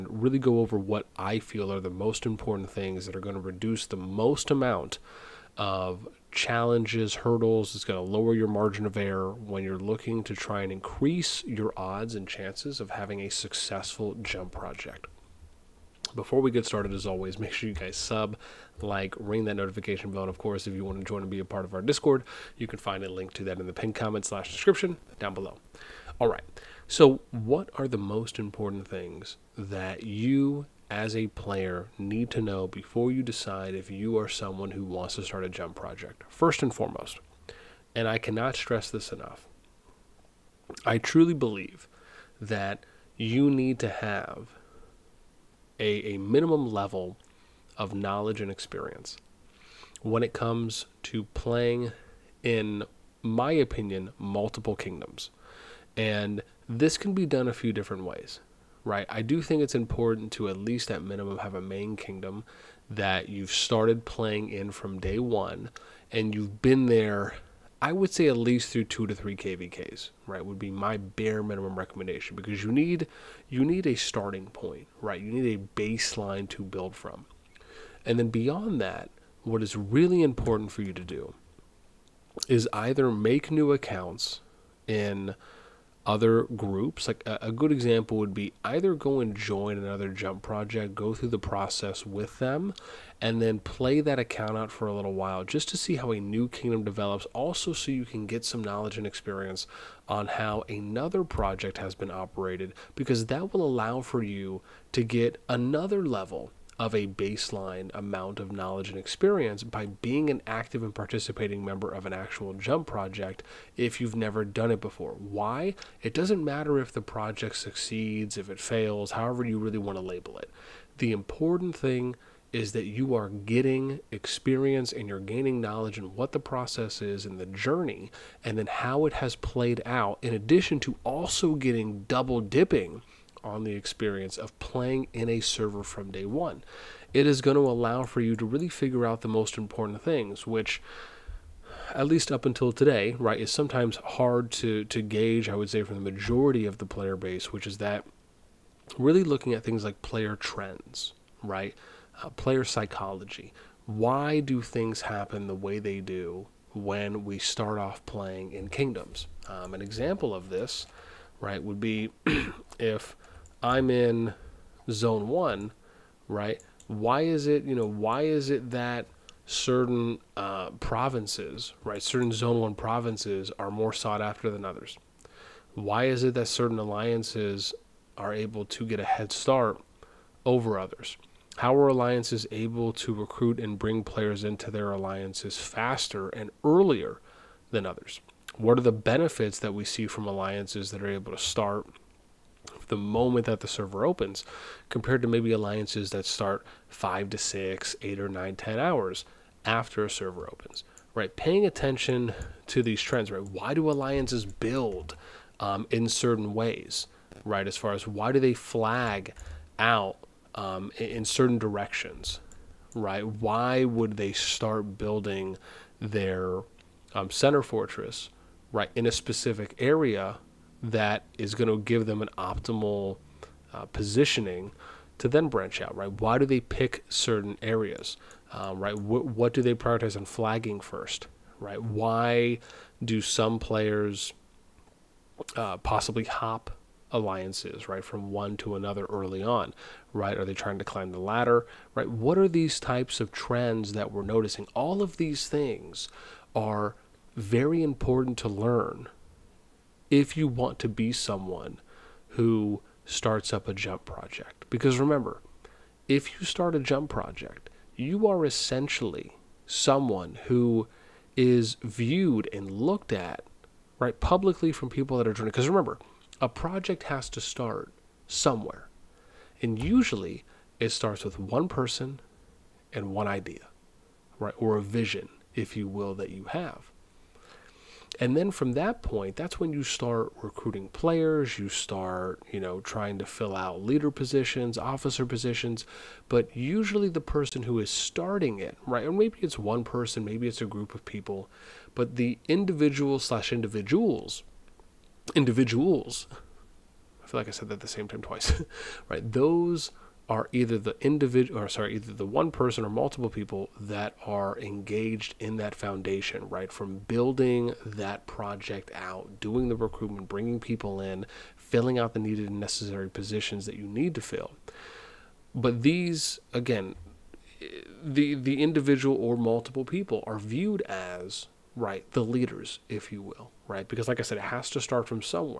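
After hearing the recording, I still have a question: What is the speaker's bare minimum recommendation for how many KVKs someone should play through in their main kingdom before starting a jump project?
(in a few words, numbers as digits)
2 to 3.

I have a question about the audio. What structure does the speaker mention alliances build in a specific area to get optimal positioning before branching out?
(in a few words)
center fortress.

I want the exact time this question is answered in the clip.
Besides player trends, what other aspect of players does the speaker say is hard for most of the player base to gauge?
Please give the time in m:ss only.
2:32.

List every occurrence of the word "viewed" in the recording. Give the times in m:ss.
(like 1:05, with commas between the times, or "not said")
4:21, 5:20.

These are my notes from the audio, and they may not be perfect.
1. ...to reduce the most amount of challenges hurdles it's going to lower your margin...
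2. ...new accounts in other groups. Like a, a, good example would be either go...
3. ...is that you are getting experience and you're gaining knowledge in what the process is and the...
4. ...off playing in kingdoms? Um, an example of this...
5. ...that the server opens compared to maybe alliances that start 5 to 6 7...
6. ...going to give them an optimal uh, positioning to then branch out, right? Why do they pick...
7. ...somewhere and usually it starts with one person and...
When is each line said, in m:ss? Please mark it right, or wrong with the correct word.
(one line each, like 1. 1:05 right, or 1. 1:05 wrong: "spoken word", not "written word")
1. 0:03 right
2. 1:23 right
3. 2:02 right
4. 2:37 right
5. 3:13 wrong: "8", not "7"
6. 3:41 right
7. 4:28 right.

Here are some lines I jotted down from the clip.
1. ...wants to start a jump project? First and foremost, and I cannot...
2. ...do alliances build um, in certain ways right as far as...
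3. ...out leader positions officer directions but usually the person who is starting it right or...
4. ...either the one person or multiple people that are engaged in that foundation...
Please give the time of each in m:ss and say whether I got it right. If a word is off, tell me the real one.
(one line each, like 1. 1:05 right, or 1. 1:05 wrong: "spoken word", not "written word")
1. 0:34 right
2. 3:23 right
3. 4:43 wrong: "positions", not "directions"
4. 5:01 right.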